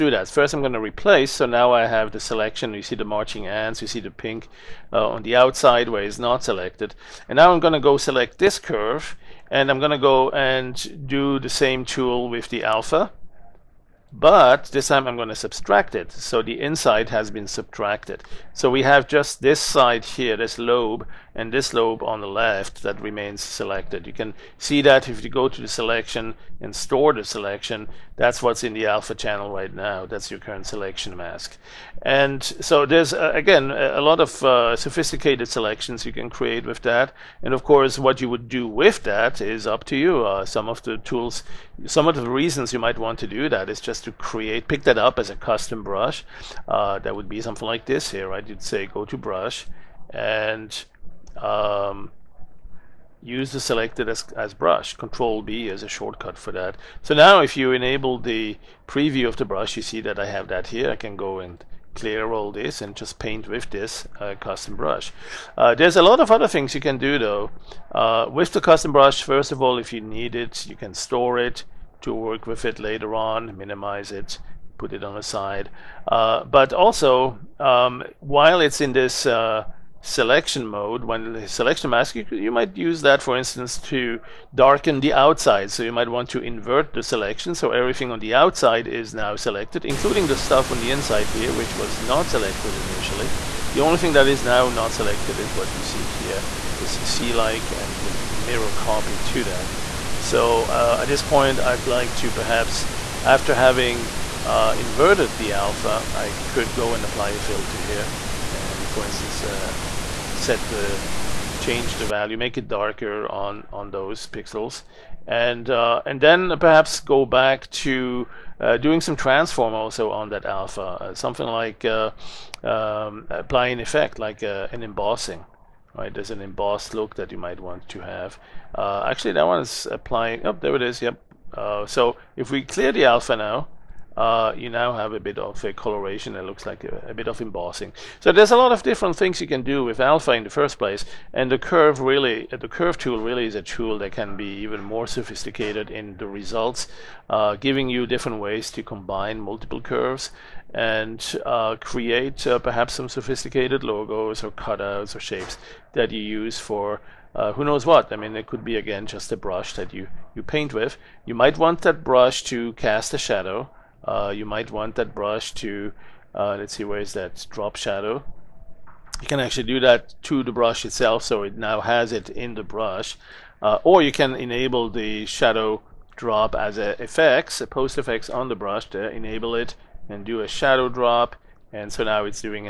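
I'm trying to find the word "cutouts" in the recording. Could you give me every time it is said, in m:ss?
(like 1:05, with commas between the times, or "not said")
2:34.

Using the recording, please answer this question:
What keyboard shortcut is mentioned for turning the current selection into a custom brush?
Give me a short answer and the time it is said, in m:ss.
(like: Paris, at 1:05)
Control B, at 0:54.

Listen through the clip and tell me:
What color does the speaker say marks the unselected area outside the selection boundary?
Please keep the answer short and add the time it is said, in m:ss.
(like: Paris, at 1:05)
pink, at 0:04.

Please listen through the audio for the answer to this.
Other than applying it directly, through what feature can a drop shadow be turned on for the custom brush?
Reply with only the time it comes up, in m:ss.
2:57.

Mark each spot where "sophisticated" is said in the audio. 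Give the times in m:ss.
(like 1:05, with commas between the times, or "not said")
0:34, 2:25, 2:33.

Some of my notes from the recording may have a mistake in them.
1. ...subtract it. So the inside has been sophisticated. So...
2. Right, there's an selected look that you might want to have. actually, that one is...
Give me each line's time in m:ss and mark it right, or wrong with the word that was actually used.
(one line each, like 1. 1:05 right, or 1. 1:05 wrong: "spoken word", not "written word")
1. 0:15 wrong: "subtracted", not "sophisticated"
2. 2:05 wrong: "embossed", not "selected".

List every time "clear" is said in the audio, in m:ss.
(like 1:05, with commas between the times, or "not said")
1:01, 2:12.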